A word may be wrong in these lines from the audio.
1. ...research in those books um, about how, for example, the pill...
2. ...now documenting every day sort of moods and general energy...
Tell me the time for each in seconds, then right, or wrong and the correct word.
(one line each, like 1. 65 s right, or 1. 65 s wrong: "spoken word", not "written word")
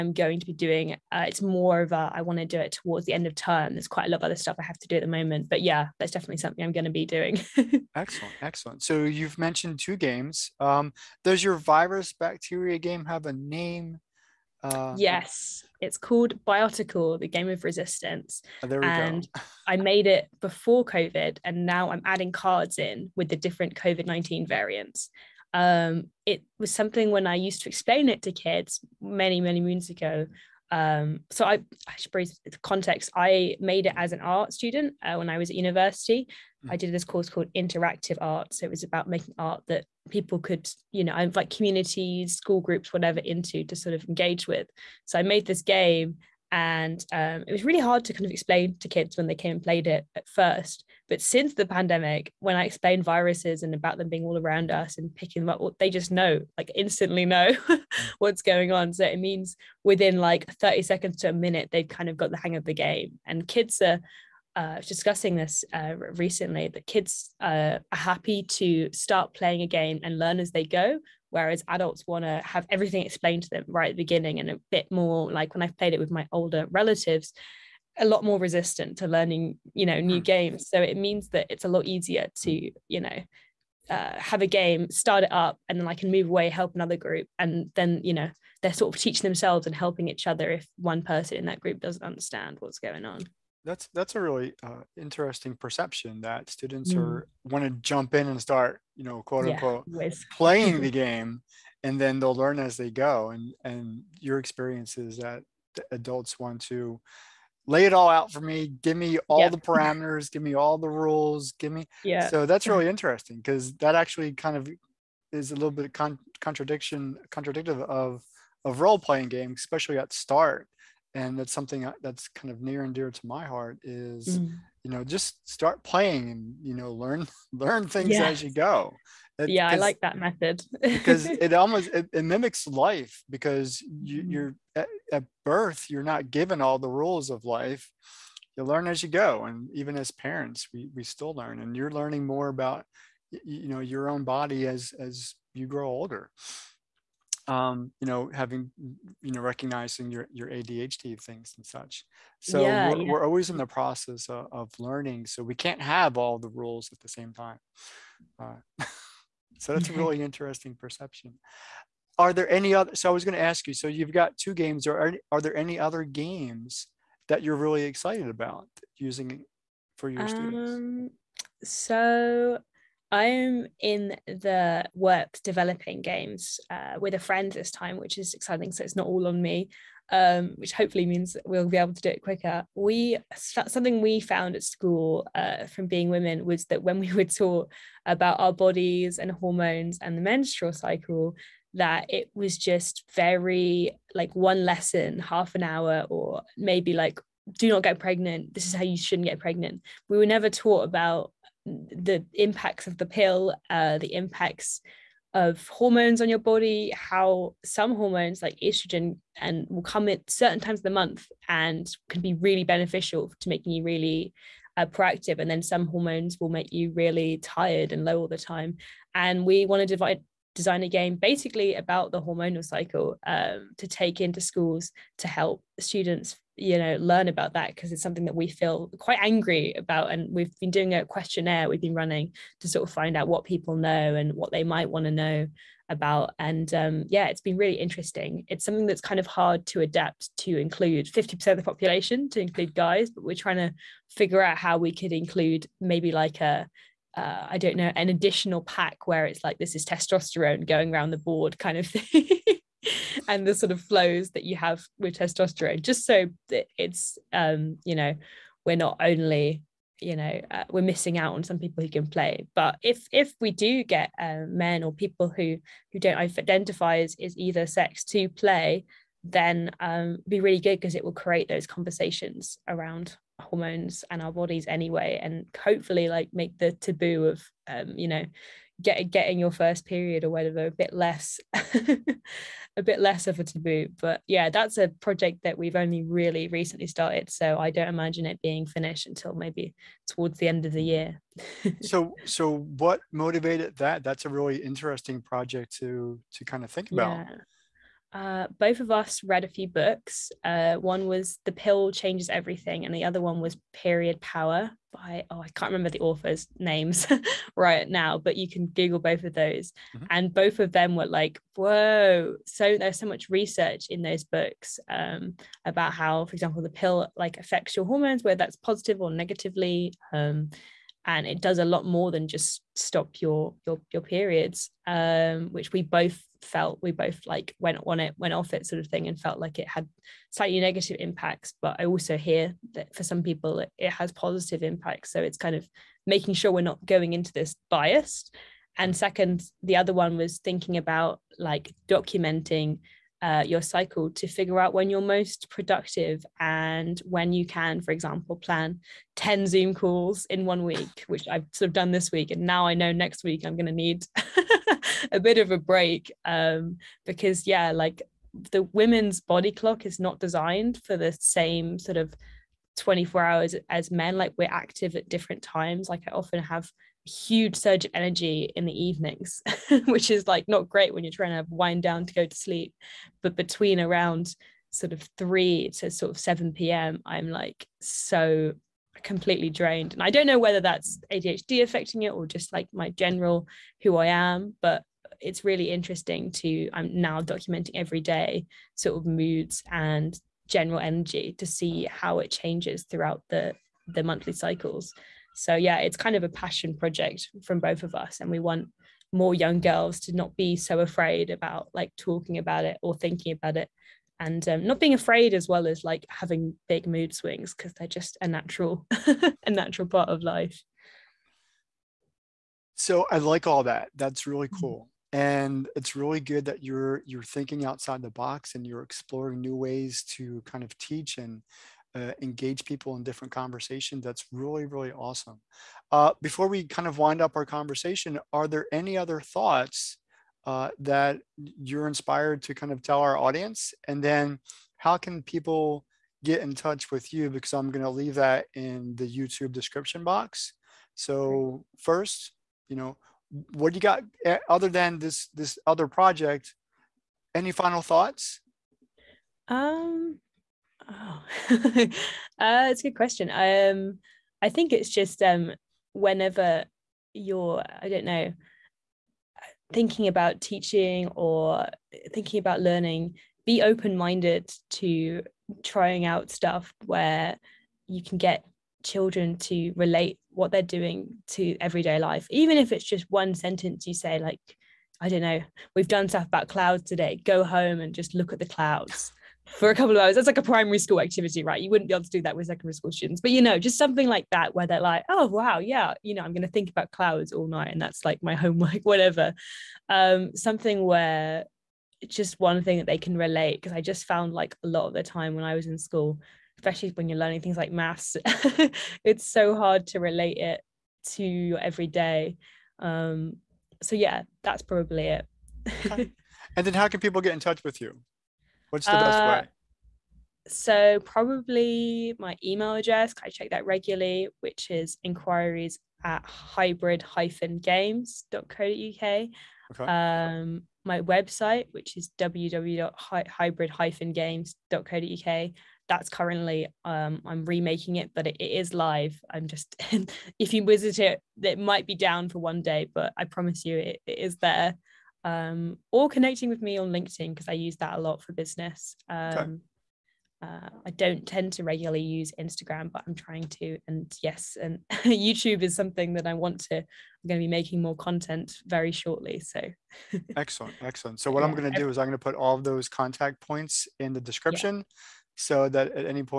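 1. 313 s right
2. 386 s right.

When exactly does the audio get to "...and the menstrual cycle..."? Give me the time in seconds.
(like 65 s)
189 s.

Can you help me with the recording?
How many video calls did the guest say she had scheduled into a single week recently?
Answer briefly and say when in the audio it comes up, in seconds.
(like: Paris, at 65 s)
10, at 349 s.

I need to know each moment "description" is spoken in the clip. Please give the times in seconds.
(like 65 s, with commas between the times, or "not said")
439 s, 554 s.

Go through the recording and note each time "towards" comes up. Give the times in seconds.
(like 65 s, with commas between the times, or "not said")
2 s, 290 s.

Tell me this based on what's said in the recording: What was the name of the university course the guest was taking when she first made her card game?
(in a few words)
Interactive art.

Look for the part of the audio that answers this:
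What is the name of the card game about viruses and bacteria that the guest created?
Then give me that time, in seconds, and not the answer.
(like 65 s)
16 s.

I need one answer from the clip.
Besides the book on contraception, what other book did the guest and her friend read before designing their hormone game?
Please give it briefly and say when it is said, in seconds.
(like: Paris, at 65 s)
Period Power, at 303 s.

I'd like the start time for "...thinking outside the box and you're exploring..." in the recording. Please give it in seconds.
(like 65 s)
417 s.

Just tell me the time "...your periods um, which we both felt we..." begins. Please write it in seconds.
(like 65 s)
323 s.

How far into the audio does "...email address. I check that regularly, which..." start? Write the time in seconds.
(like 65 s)
512 s.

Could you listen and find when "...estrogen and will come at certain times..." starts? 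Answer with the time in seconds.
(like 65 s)
208 s.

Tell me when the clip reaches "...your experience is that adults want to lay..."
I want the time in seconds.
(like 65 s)
104 s.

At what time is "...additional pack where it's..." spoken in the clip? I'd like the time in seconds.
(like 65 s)
248 s.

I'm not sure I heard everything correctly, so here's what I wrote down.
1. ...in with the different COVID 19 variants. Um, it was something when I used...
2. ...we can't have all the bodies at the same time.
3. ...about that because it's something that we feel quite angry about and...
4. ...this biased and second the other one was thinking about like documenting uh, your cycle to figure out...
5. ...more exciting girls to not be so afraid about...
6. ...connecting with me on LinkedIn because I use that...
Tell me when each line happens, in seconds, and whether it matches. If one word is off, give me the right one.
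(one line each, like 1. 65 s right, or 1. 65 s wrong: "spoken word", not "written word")
1. 22 s right
2. 155 s wrong: "rules", not "bodies"
3. 227 s right
4. 337 s right
5. 399 s wrong: "young", not "exciting"
6. 536 s right.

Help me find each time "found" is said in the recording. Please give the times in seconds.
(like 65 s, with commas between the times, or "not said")
184 s, 494 s.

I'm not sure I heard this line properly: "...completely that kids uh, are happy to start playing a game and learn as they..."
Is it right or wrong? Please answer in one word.
wrong.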